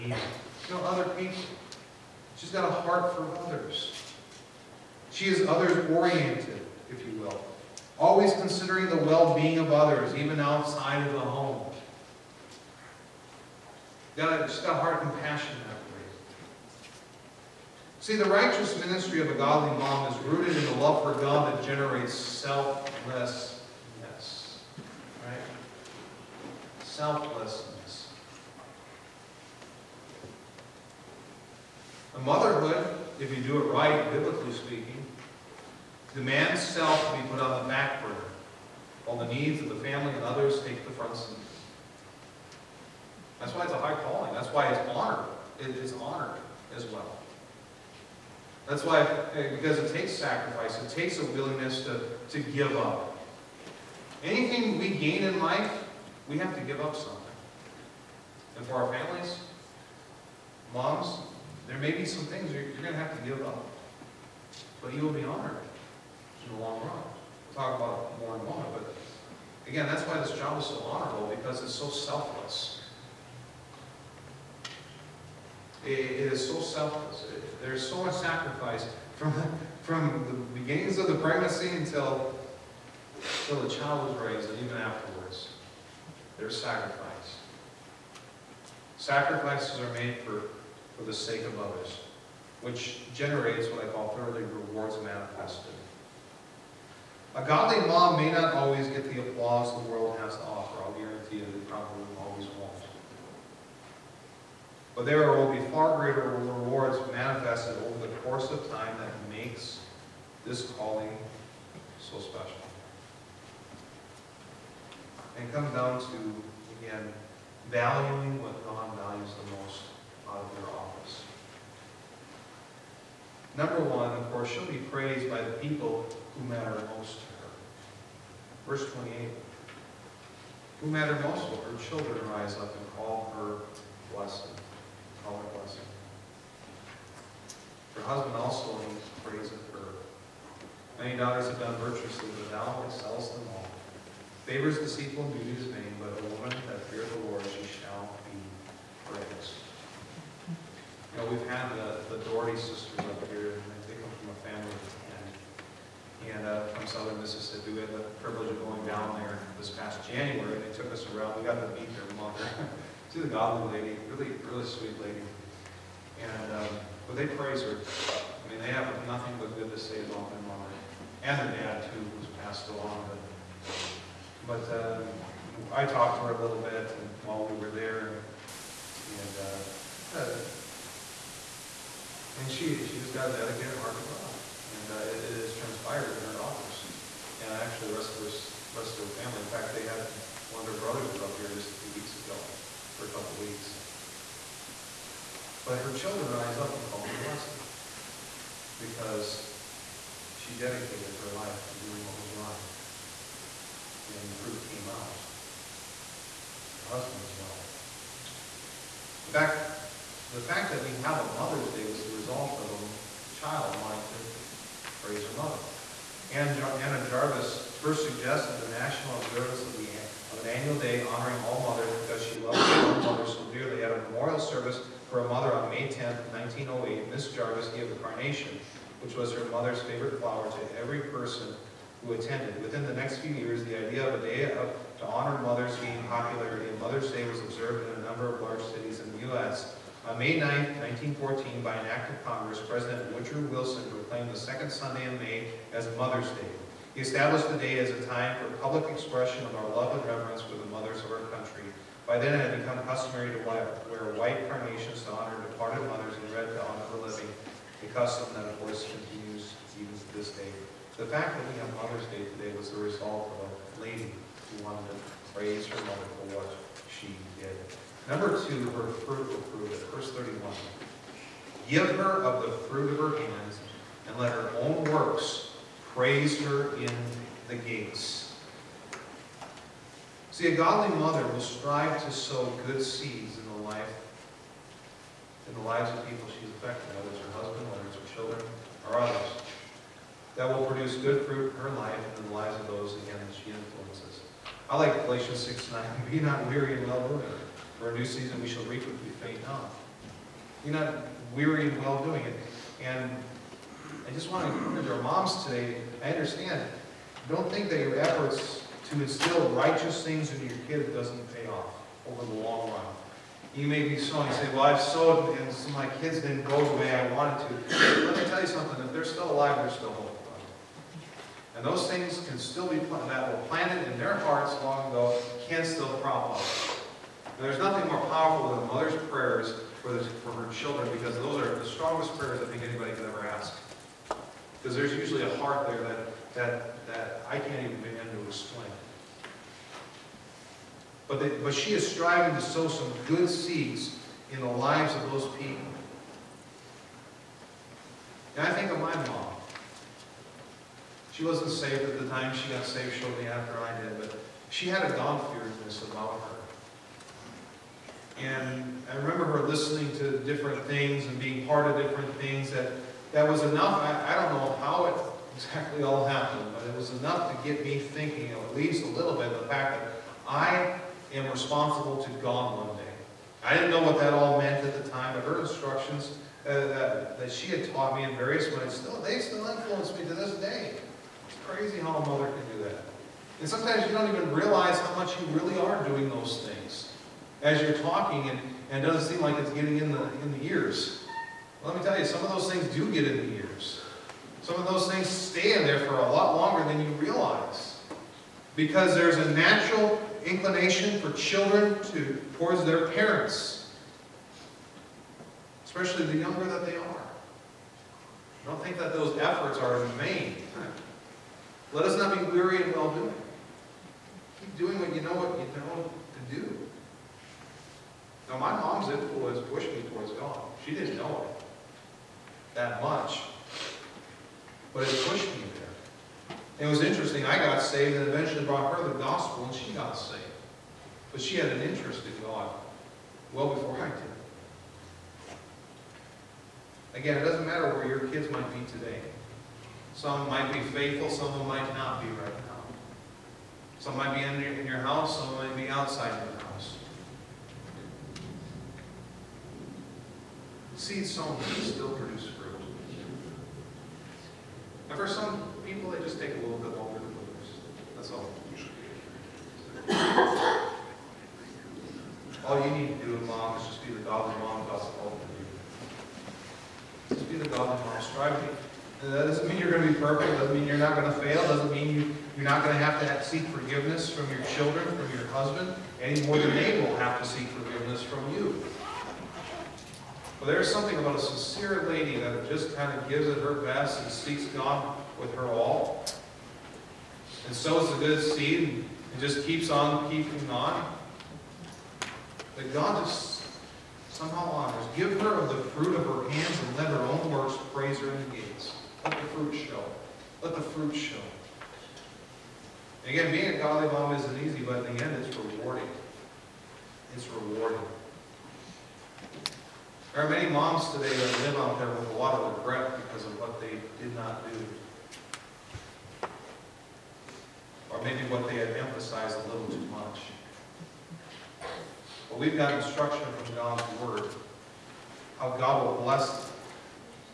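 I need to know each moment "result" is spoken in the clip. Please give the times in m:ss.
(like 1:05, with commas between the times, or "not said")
3:32, 4:22.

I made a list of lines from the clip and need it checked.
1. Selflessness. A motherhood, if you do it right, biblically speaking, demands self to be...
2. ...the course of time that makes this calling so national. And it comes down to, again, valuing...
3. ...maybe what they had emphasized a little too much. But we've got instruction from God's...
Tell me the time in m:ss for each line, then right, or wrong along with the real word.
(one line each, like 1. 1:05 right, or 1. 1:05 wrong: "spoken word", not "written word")
1. 0:26 right
2. 1:48 wrong: "special", not "national"
3. 8:38 right.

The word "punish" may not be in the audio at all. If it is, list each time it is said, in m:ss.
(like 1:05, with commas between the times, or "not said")
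not said.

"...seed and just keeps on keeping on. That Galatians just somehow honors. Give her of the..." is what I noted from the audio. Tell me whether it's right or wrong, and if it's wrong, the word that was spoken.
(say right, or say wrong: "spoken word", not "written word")
wrong: "God", not "Galatians".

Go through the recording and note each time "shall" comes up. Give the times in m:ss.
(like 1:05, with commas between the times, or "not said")
2:27, 4:58.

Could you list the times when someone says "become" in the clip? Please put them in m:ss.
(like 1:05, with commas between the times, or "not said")
4:12.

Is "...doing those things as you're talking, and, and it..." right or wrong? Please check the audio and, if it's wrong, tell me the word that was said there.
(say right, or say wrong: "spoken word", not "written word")
right.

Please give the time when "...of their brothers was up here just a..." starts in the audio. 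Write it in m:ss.
3:10.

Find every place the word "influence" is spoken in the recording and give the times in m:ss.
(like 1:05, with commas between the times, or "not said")
4:53, 6:19, 6:58.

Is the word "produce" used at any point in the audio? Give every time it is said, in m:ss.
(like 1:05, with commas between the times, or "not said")
4:50, 7:31, 7:37.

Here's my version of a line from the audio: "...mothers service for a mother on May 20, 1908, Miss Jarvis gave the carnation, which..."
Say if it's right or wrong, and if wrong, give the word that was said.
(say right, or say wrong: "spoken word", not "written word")
wrong: "10", not "20".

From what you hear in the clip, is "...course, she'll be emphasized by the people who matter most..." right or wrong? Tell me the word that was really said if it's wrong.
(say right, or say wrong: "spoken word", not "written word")
wrong: "praised", not "emphasized".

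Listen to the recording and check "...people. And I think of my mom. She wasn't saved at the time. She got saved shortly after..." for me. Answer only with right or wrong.
right.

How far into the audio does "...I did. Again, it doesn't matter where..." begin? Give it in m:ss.
7:13.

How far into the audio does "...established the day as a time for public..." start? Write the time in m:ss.
4:07.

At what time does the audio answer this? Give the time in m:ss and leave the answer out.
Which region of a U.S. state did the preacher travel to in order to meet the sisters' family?
2:36.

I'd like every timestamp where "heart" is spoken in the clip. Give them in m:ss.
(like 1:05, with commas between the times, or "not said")
0:02, 0:14, 3:03, 5:24, 5:35.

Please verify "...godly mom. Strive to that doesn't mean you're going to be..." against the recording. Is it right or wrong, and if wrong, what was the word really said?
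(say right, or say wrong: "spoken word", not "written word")
right.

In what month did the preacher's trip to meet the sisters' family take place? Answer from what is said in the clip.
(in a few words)
January.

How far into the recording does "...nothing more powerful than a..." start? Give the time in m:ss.
5:27.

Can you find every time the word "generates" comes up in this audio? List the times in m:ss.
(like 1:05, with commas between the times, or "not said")
0:21, 1:33.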